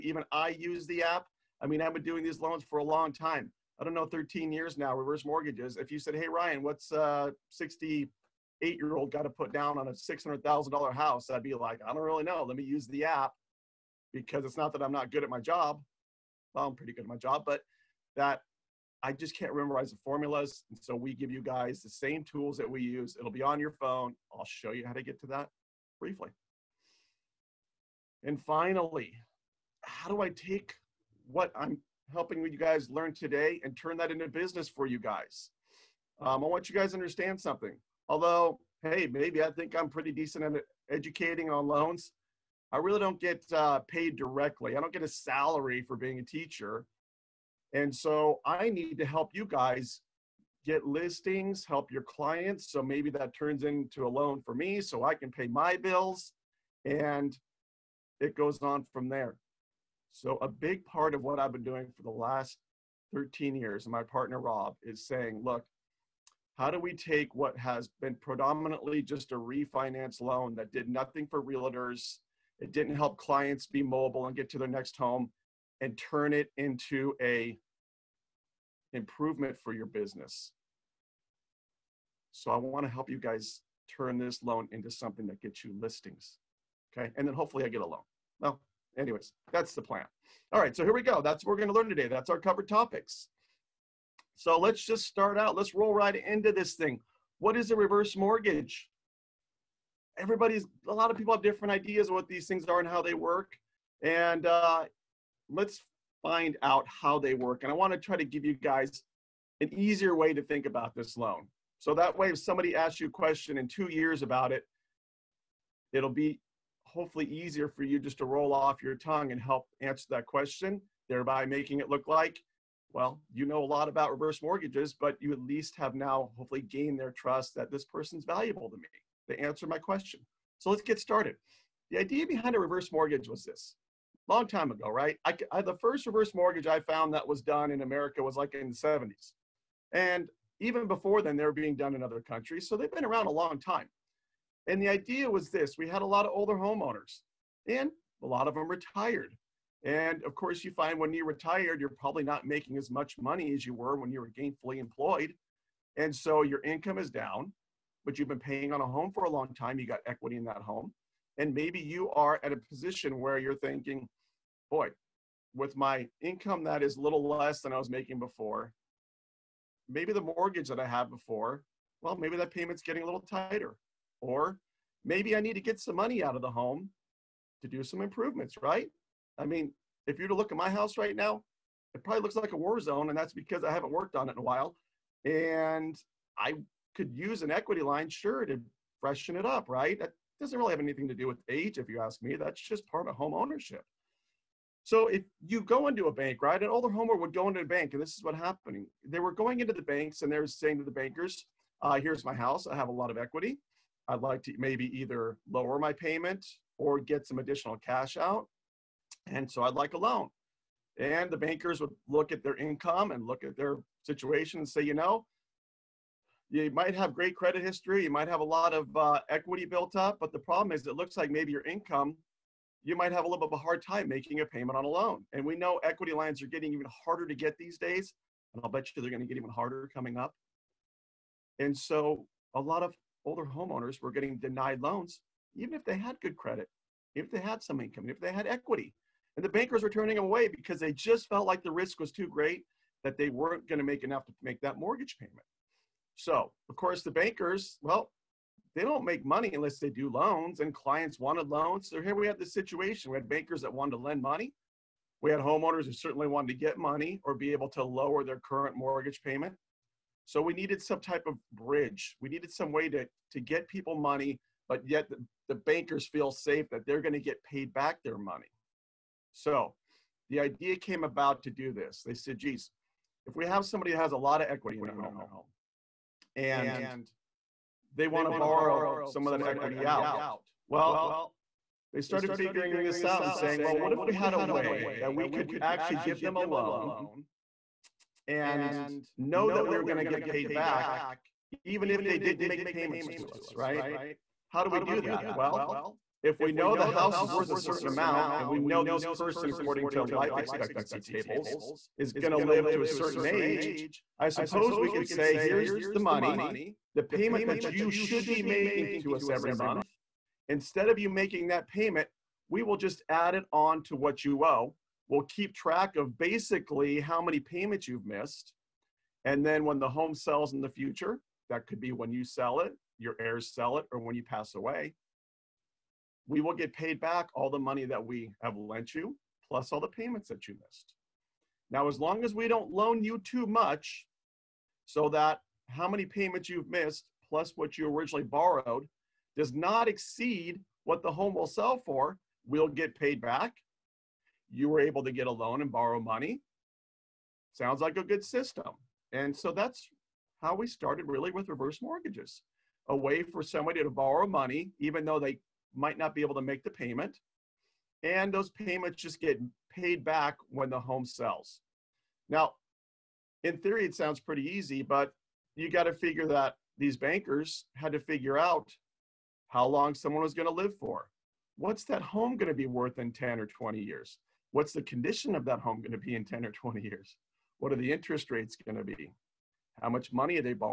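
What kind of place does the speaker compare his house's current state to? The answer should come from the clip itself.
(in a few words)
a war zone.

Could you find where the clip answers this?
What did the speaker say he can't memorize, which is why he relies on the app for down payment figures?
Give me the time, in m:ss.
0:19.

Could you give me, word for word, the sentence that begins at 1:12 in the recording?
It didn't help clients be mobile and get to their next home and turn it into a improvement for your business.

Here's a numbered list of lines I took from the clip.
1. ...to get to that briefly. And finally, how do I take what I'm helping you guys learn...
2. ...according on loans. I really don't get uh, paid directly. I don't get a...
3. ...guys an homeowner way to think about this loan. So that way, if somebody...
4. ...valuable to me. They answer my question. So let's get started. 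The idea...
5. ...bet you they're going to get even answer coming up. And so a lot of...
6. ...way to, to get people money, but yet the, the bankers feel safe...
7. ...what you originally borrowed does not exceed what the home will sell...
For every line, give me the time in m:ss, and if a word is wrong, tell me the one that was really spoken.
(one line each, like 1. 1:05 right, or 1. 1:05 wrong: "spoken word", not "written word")
1. 0:24 right
2. 0:40 wrong: "educating", not "according"
3. 1:48 wrong: "easier", not "homeowner"
4. 2:08 right
5. 3:48 wrong: "harder", not "answer"
6. 4:22 right
7. 5:37 right.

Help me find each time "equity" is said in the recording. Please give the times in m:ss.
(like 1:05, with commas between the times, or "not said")
2:40, 3:07, 3:23, 3:39, 3:45, 3:58, 4:34, 4:39.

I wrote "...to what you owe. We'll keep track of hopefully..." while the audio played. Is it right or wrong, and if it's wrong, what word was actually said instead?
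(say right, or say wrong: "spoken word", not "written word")
wrong: "basically", not "hopefully".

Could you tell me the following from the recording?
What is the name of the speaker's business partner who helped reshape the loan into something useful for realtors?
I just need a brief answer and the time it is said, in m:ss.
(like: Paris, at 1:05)
Rob, at 1:04.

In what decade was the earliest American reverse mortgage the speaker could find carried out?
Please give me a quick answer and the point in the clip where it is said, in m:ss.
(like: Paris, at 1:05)
the 70s, at 2:18.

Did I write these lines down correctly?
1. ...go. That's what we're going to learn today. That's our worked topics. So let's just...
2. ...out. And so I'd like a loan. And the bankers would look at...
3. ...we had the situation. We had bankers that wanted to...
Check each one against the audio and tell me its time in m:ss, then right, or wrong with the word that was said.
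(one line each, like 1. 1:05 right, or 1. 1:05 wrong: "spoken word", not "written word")
1. 1:31 wrong: "covered", not "worked"
2. 3:28 right
3. 4:12 right.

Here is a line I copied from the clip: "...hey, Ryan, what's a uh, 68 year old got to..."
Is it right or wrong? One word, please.
right.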